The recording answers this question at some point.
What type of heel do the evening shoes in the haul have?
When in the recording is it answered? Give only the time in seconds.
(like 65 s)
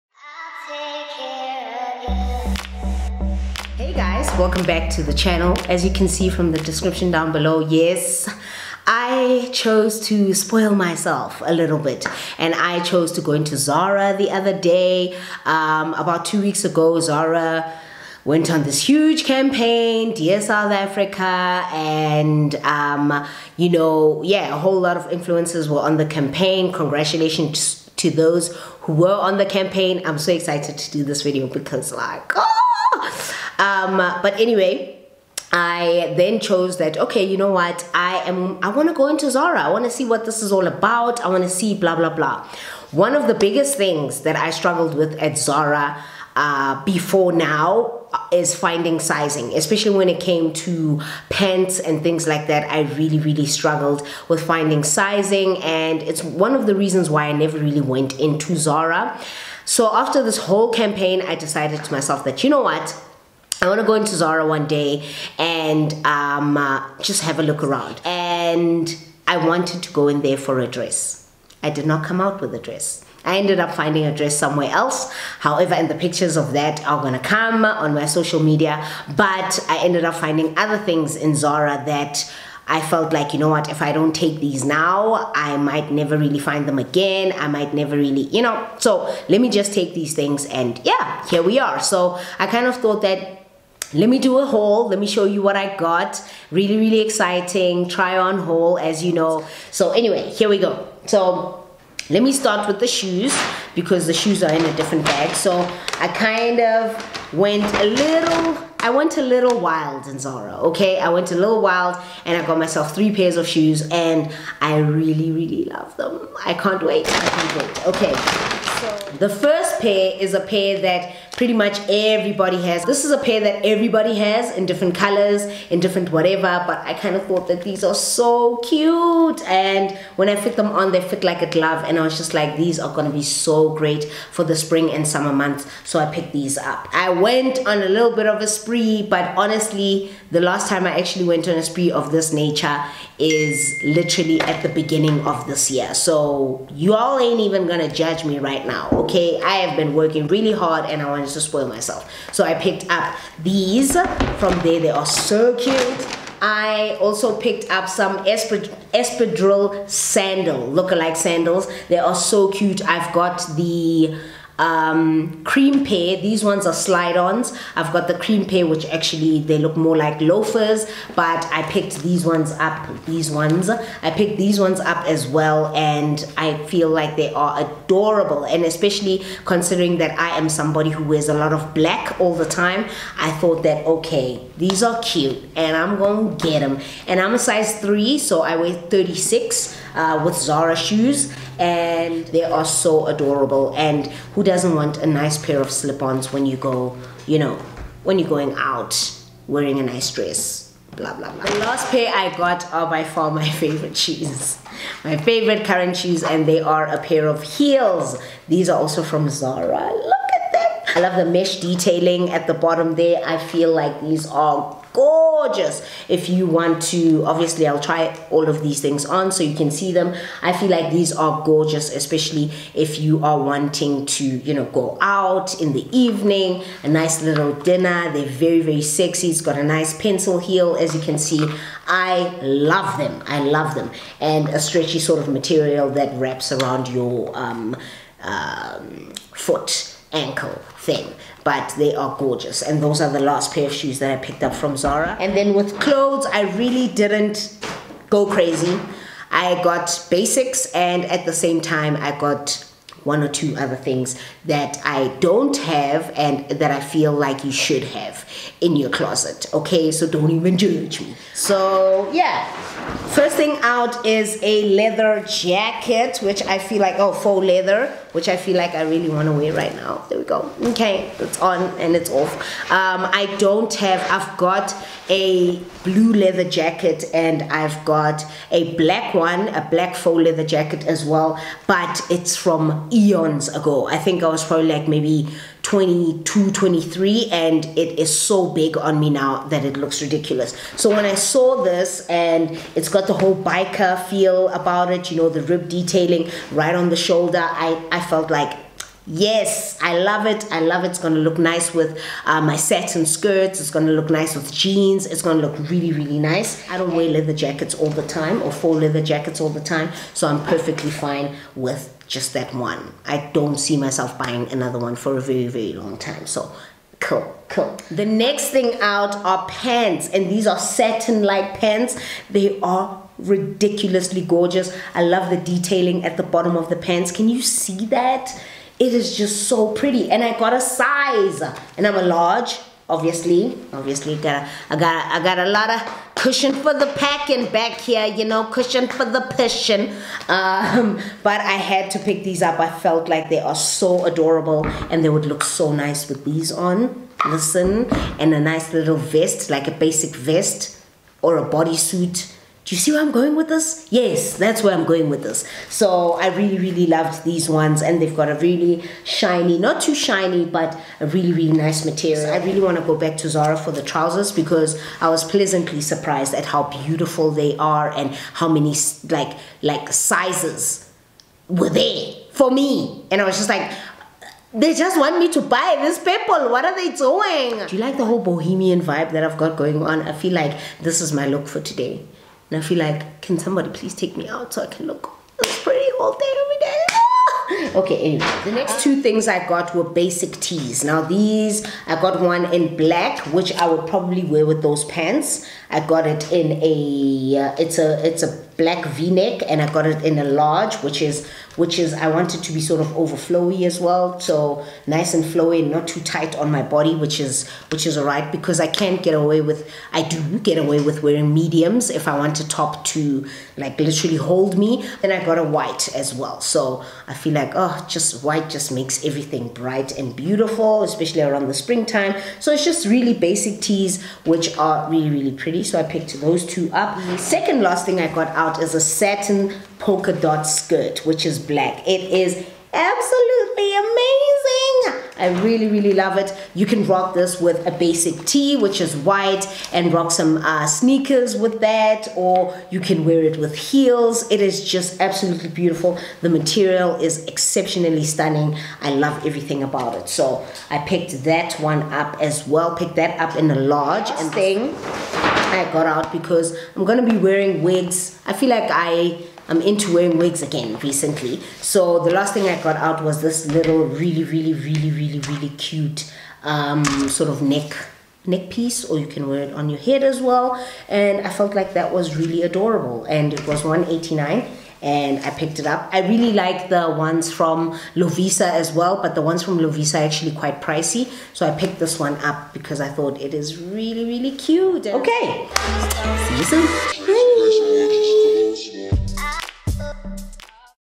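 229 s.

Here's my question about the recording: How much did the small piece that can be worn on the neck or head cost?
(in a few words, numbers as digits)
189.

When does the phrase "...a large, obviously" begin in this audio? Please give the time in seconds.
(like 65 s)
331 s.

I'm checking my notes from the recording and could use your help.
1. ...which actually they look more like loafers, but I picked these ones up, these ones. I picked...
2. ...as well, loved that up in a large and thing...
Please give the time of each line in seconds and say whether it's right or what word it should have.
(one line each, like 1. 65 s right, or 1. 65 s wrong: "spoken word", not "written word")
1. 168 s right
2. 452 s wrong: "picked", not "loved".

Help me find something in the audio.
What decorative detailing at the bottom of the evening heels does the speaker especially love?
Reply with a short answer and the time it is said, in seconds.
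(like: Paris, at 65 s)
mesh, at 211 s.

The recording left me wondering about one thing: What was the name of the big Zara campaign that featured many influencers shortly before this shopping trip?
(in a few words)
Dear South Africa.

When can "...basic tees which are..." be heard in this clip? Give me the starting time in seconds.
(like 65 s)
423 s.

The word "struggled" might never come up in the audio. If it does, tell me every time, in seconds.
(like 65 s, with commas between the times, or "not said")
44 s, 53 s.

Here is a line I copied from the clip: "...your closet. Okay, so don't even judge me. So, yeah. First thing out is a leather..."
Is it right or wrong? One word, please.
right.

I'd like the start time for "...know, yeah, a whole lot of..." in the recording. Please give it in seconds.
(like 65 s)
23 s.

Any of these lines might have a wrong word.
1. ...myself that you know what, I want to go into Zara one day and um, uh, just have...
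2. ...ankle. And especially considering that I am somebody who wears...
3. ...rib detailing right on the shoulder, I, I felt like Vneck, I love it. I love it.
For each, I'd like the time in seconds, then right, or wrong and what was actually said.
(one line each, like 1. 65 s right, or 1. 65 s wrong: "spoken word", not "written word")
1. 61 s right
2. 177 s wrong: "adorable", not "ankle"
3. 295 s wrong: "Yes", not "Vneck".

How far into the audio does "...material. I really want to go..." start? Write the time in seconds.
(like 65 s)
361 s.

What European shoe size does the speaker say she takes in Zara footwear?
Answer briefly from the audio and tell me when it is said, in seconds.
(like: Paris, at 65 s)
36, at 188 s.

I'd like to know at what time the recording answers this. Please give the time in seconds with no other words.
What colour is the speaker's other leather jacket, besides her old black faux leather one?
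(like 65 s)
275 s.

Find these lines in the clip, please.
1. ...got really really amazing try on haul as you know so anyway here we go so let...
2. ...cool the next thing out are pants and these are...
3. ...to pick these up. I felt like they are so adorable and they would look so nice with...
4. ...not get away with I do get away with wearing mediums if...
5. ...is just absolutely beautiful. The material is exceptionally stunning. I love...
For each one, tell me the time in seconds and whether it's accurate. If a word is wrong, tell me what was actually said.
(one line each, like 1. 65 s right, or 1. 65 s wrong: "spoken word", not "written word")
1. 95 s wrong: "exciting", not "amazing"
2. 317 s right
3. 341 s right
4. 408 s right
5. 444 s right.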